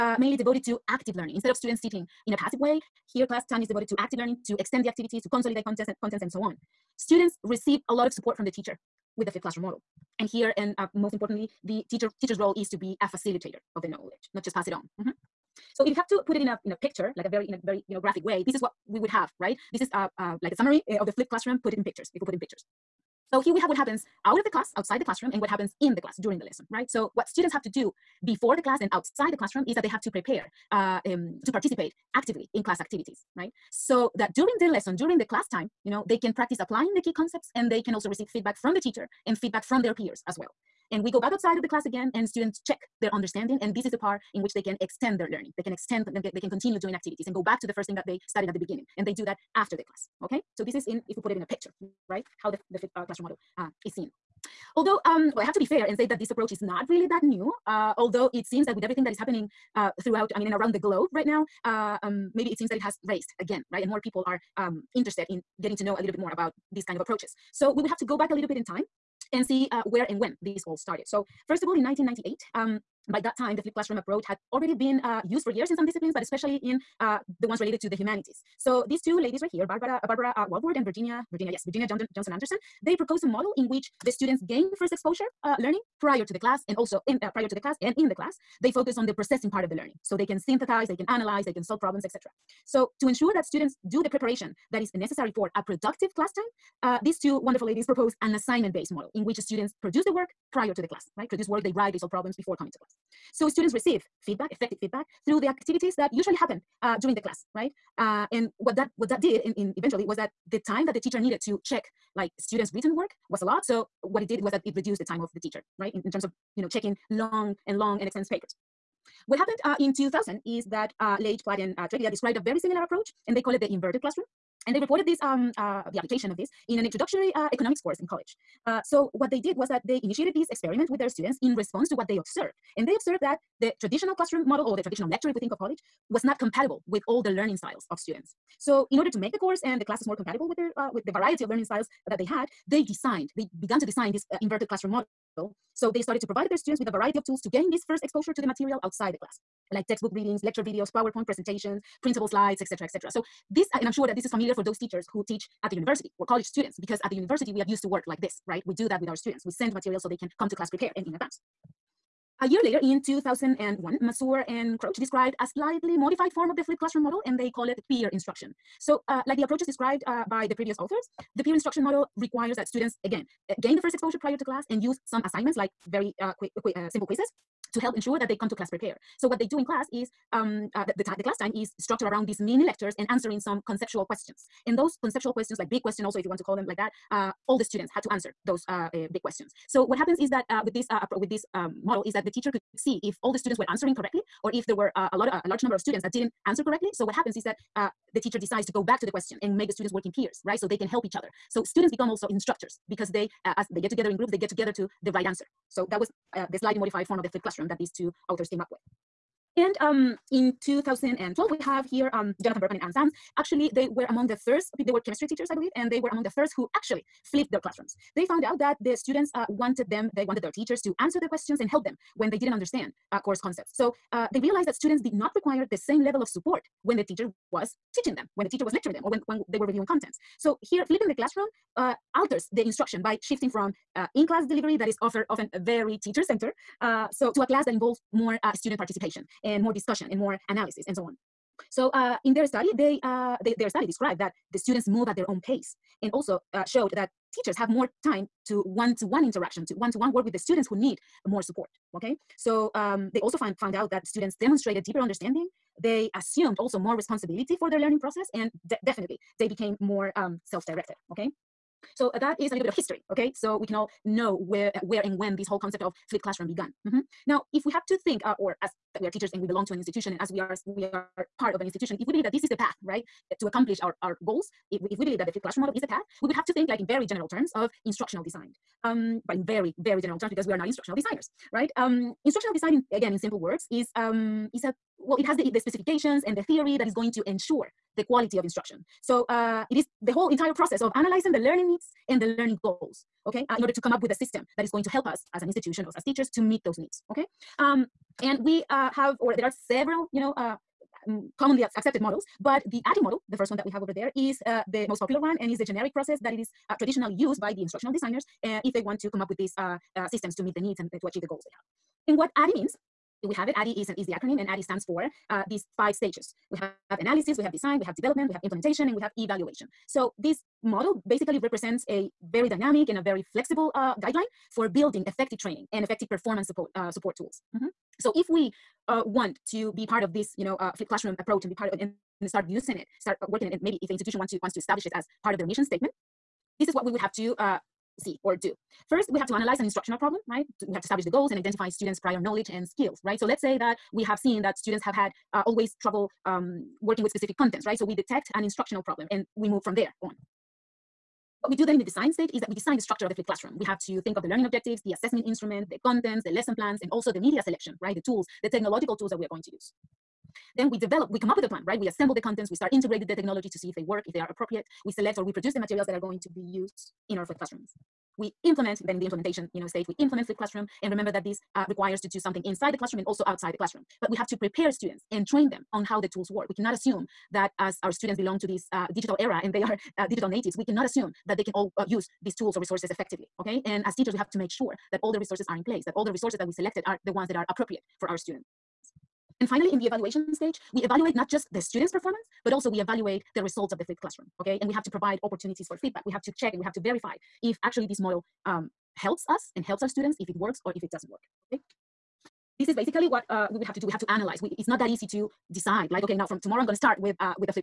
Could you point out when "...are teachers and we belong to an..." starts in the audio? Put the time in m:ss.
4:29.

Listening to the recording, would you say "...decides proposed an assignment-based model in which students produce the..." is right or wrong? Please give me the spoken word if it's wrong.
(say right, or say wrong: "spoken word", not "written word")
wrong: "ladies", not "decides".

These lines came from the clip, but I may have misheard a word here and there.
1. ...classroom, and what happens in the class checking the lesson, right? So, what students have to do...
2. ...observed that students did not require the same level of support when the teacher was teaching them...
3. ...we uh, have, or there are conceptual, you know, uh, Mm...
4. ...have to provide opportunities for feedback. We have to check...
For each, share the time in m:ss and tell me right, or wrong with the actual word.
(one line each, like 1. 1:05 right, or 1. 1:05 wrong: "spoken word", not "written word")
1. 0:25 wrong: "during", not "checking"
2. 3:44 wrong: "realized", not "observed"
3. 4:58 wrong: "several", not "conceptual"
4. 6:34 right.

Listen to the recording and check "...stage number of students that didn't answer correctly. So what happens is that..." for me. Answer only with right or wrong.
wrong.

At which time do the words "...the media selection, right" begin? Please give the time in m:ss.
5:57.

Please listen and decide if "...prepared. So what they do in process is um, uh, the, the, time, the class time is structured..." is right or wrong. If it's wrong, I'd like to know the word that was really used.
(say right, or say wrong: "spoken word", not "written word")
wrong: "class", not "process".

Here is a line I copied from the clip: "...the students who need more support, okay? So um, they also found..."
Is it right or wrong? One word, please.
right.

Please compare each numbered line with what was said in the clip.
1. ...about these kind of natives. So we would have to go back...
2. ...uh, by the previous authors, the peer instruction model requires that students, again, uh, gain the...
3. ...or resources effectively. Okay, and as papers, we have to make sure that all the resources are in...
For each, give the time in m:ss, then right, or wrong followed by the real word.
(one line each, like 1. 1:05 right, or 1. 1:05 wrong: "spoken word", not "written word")
1. 1:06 wrong: "approaches", not "natives"
2. 2:50 right
3. 6:22 wrong: "teachers", not "papers".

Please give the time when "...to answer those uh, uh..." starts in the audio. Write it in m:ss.
3:08.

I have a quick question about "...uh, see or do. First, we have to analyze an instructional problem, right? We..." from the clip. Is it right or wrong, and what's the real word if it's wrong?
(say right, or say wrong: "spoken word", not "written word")
right.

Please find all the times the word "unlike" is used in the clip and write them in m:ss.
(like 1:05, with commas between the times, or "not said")
not said.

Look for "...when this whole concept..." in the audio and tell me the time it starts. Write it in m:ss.
4:25.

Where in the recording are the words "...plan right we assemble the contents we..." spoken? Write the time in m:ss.
6:01.